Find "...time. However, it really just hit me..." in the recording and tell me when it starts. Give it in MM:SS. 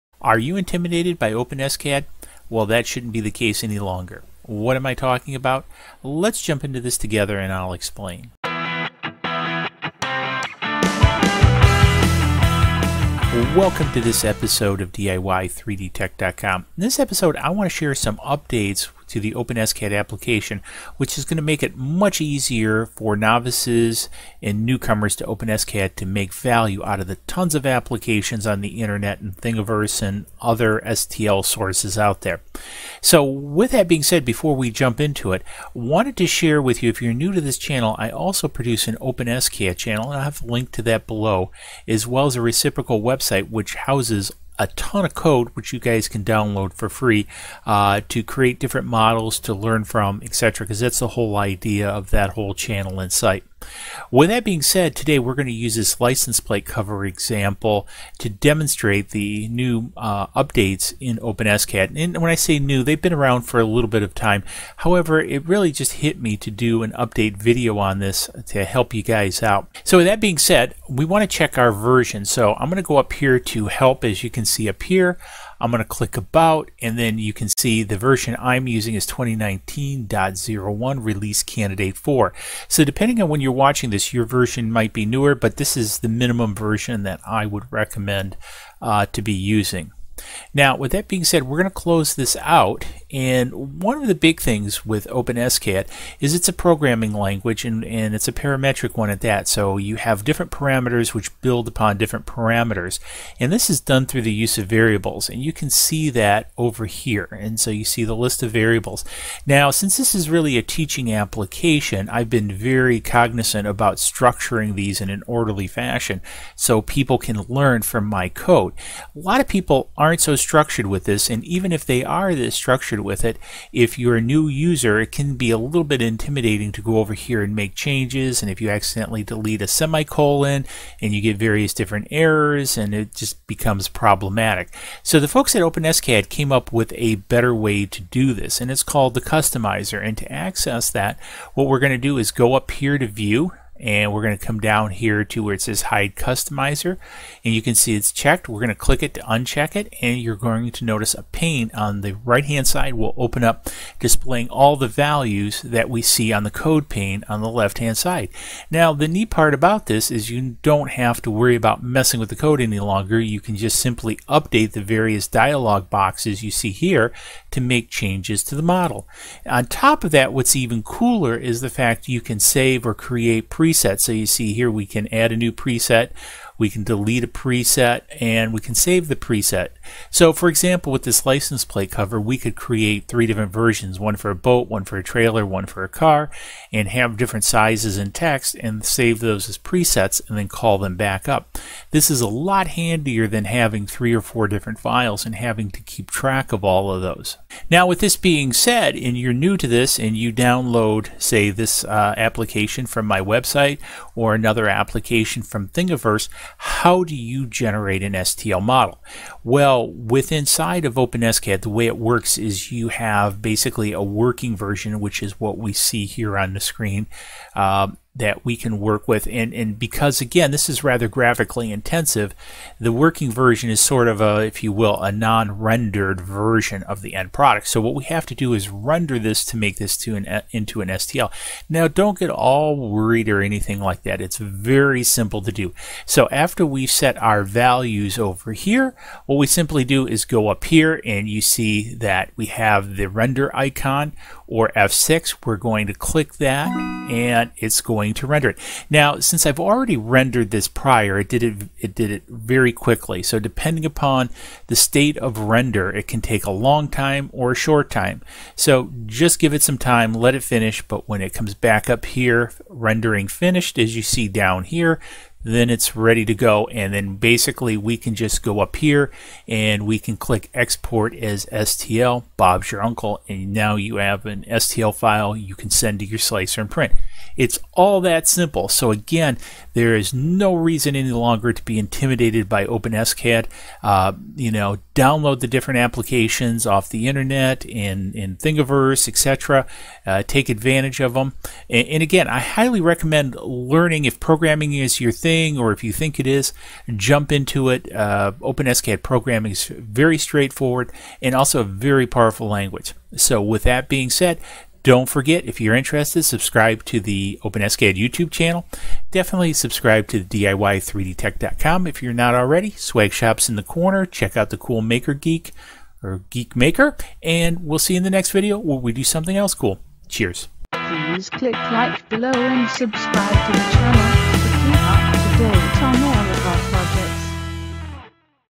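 01:04.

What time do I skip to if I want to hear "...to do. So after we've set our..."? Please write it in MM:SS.
03:55.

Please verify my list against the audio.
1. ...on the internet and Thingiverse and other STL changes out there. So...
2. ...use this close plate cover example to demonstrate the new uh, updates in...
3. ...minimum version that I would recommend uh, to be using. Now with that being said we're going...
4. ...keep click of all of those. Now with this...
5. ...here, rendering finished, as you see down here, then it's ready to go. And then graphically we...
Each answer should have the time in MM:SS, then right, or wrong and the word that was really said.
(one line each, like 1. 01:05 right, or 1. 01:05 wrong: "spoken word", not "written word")
1. 00:28 wrong: "sources", not "changes"
2. 00:55 wrong: "license", not "close"
3. 01:26 right
4. 03:15 wrong: "track", not "click"
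5. 04:22 wrong: "basically", not "graphically".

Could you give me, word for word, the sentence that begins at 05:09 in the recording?
Definitely subscribe to the DIY3DTech.com if you're not already.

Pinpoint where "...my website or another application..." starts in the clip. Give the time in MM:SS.
03:23.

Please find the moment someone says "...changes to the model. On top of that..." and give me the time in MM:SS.
02:47.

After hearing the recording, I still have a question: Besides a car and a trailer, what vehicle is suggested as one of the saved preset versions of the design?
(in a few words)
A boat.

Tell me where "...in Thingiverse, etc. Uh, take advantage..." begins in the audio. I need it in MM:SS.
04:48.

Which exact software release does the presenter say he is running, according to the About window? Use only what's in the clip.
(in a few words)
2019.01 release candidate 4.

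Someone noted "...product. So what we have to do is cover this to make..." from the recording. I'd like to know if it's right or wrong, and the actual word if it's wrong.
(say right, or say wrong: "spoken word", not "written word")
wrong: "render", not "cover".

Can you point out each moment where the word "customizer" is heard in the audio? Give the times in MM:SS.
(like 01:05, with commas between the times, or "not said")
02:19, 02:26.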